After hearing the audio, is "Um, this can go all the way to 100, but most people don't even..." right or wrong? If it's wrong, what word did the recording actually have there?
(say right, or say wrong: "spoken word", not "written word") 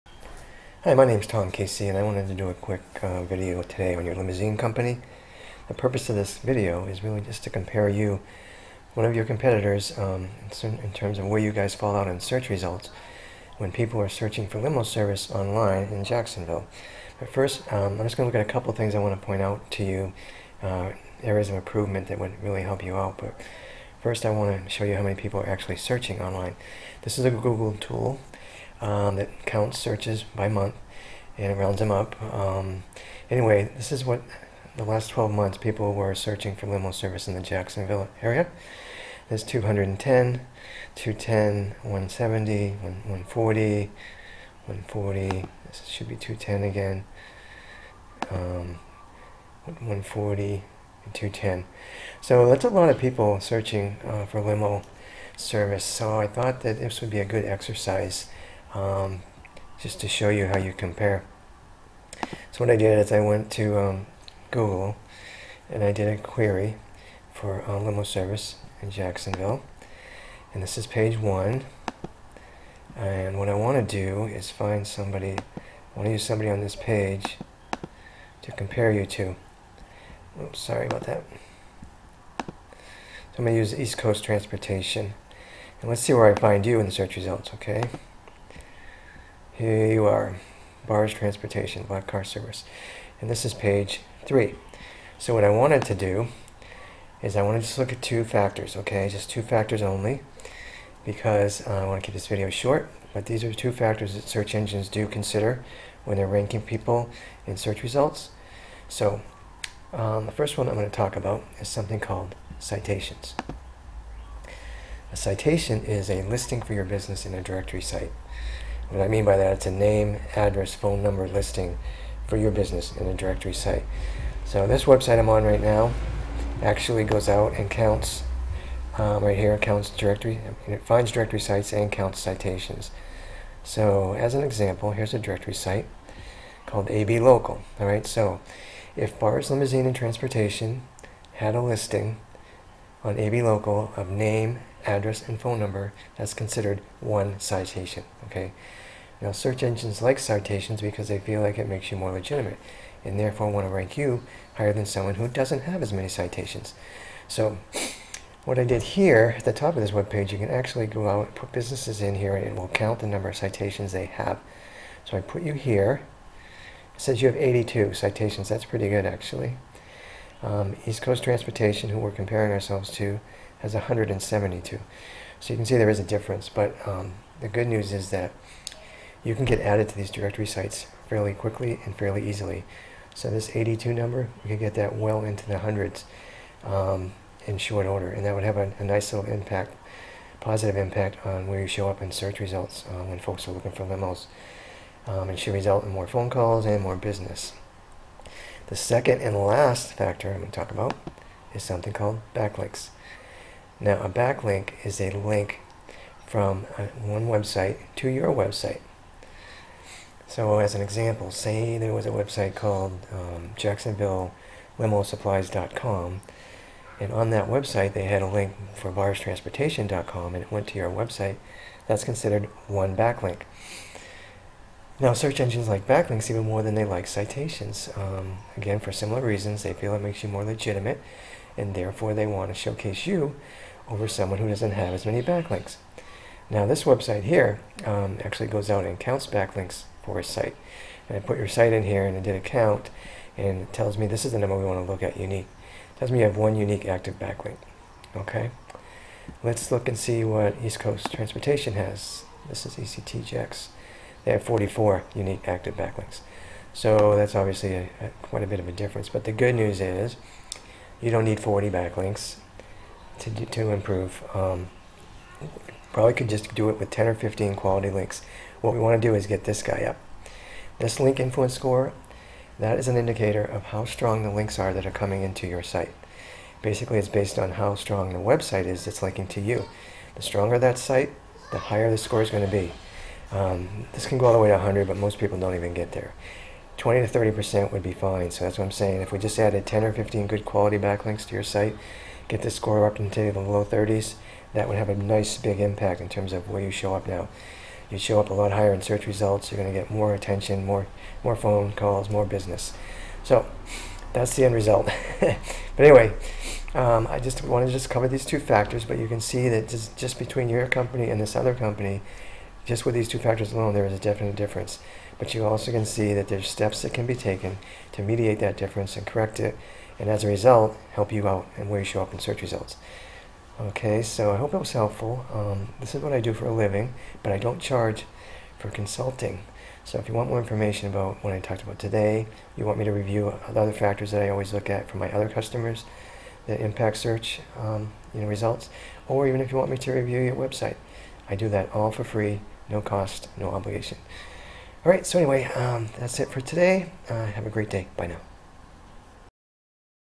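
right.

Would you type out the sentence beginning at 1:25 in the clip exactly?
And let's see where I find you in the search results, okay?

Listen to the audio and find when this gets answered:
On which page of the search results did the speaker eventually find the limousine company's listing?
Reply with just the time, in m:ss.
1:33.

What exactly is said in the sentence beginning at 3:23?
Now, a backlink is a link from one website to your website.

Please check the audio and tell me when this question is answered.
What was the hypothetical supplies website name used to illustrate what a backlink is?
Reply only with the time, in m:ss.
3:33.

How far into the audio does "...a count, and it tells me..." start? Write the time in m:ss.
4:02.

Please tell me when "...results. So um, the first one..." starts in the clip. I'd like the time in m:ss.
1:47.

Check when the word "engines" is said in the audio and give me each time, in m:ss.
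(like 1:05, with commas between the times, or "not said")
1:44, 2:29, 3:45.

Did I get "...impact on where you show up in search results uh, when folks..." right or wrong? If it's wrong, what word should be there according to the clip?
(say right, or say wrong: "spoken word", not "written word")
right.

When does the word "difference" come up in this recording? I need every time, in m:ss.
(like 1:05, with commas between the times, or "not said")
2:56, 4:18, 5:14, 5:18.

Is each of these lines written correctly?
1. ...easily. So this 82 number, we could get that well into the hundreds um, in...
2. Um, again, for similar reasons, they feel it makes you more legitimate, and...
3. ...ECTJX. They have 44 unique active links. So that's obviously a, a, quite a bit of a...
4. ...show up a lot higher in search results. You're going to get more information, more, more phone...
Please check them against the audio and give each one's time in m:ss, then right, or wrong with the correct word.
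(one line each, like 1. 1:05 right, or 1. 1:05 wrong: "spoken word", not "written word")
1. 3:02 right
2. 3:47 right
3. 4:12 wrong: "backlinks", not "links"
4. 4:57 wrong: "attention", not "information".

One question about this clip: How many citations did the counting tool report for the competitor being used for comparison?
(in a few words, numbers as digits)
172.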